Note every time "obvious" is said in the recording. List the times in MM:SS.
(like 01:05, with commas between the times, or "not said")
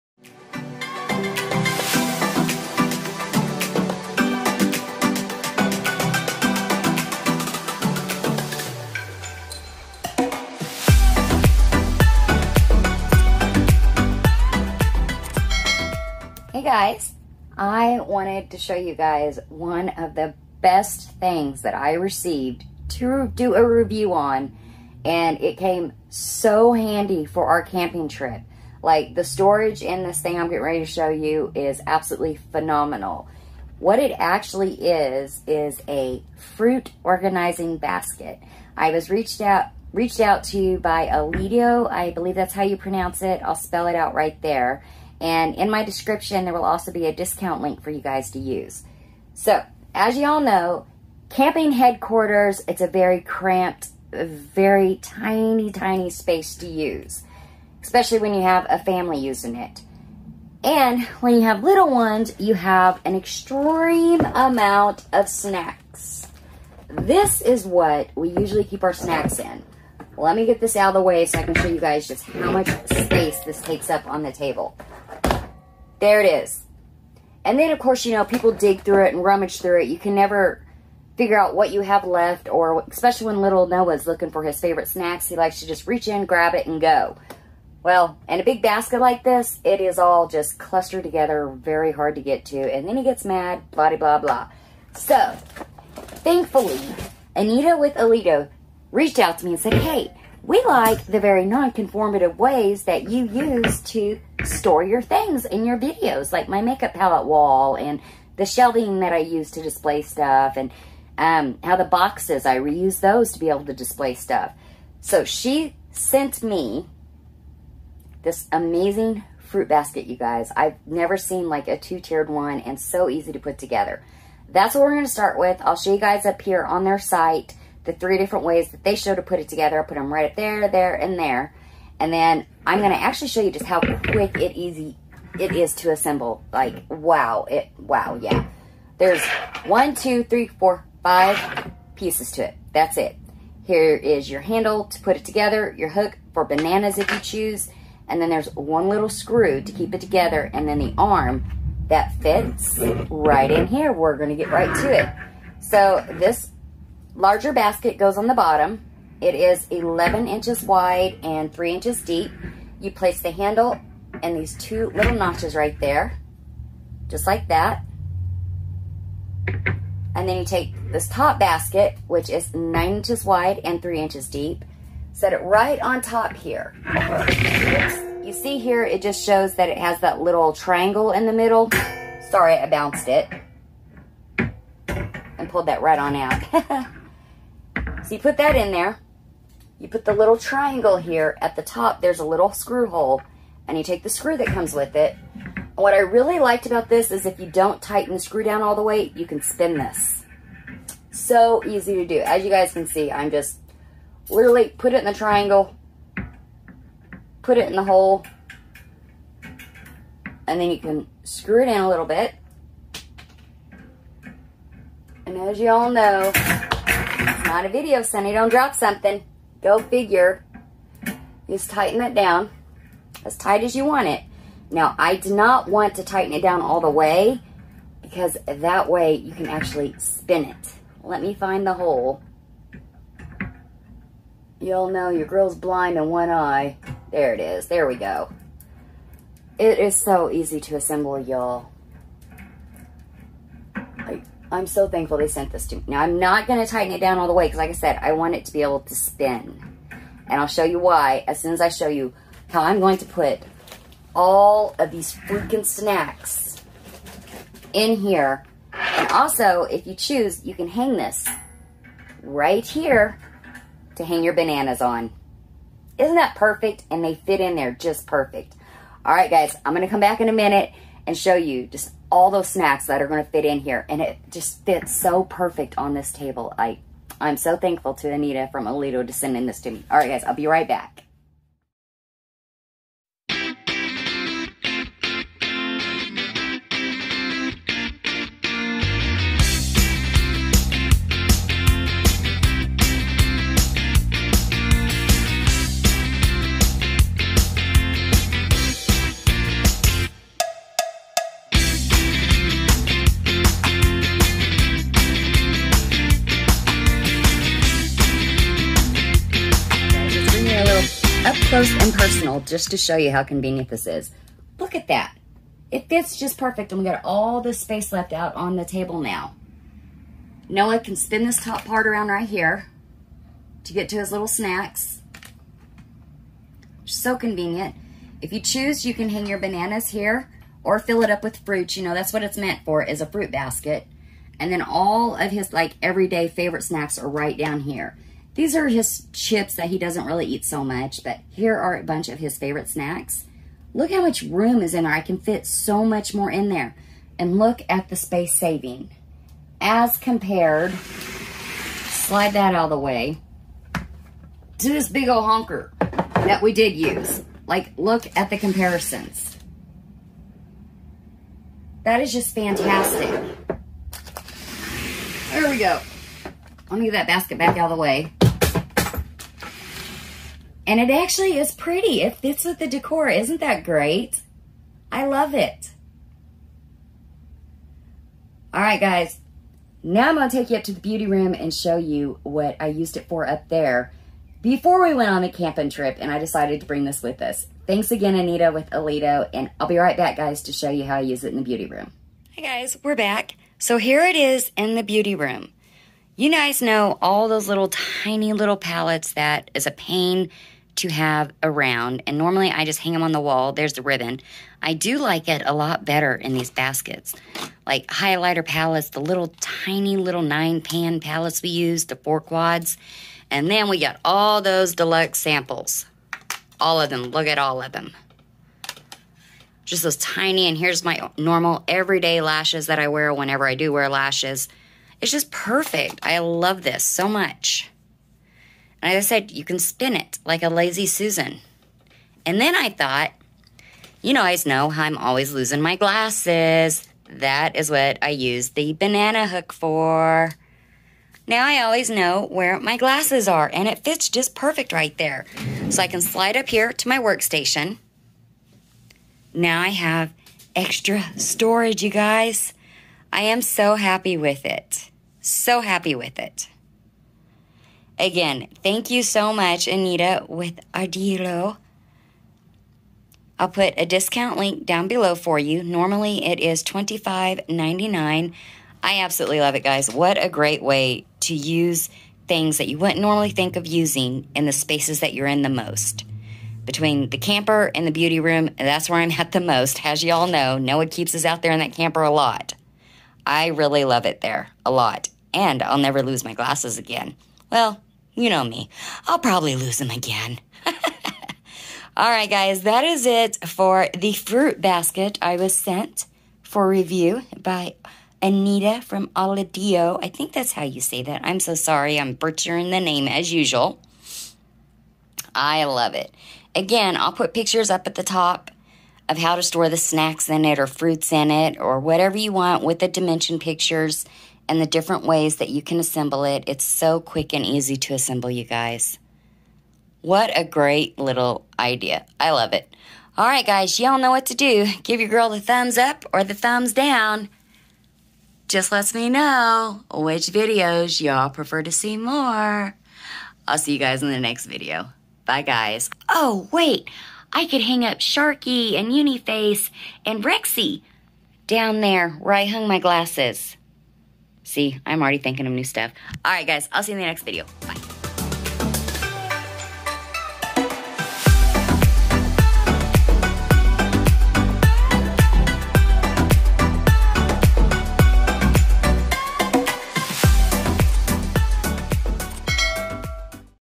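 not said.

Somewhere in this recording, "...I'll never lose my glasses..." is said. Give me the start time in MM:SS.
08:05.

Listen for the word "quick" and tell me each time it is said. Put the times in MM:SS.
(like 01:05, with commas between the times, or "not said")
02:13, 08:36.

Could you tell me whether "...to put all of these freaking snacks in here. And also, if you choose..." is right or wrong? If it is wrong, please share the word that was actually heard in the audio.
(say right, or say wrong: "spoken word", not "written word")
right.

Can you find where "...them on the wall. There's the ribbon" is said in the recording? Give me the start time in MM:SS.
06:42.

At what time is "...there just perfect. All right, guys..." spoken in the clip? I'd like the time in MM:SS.
04:27.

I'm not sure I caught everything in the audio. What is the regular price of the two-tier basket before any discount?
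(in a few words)
$25.99.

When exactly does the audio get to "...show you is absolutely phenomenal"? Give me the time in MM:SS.
00:30.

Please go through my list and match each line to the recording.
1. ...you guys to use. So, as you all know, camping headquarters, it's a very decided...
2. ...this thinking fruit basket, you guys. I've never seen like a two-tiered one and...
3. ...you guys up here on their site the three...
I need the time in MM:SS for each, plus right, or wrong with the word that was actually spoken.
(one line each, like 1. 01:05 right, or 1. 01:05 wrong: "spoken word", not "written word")
1. 00:47 wrong: "cramped", not "decided"
2. 01:58 wrong: "amazing", not "thinking"
3. 02:05 right.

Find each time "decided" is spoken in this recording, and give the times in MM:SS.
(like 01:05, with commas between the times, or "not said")
06:26.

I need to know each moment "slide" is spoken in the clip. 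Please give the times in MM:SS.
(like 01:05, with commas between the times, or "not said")
05:51, 07:26.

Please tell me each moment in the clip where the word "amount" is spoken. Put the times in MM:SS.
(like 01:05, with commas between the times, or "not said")
01:04.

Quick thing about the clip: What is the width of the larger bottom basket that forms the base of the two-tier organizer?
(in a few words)
11 inches.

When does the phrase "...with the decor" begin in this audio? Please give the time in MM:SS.
06:12.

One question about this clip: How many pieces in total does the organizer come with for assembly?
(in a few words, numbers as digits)
5.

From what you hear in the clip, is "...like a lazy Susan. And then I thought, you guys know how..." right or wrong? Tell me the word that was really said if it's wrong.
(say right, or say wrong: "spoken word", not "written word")
right.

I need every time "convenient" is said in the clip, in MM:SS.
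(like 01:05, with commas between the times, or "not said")
05:13, 05:27.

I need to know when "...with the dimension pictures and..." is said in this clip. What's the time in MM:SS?
08:32.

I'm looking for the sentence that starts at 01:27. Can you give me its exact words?
Well, in a big basket like this, it is all just clustered together, very hard to get to.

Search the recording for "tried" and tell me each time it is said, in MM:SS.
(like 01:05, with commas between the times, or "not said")
not said.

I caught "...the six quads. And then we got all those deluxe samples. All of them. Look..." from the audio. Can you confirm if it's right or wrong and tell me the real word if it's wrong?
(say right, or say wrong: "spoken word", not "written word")
wrong: "four", not "six".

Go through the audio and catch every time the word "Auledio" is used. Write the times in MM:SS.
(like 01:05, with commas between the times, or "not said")
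00:41, 08:19.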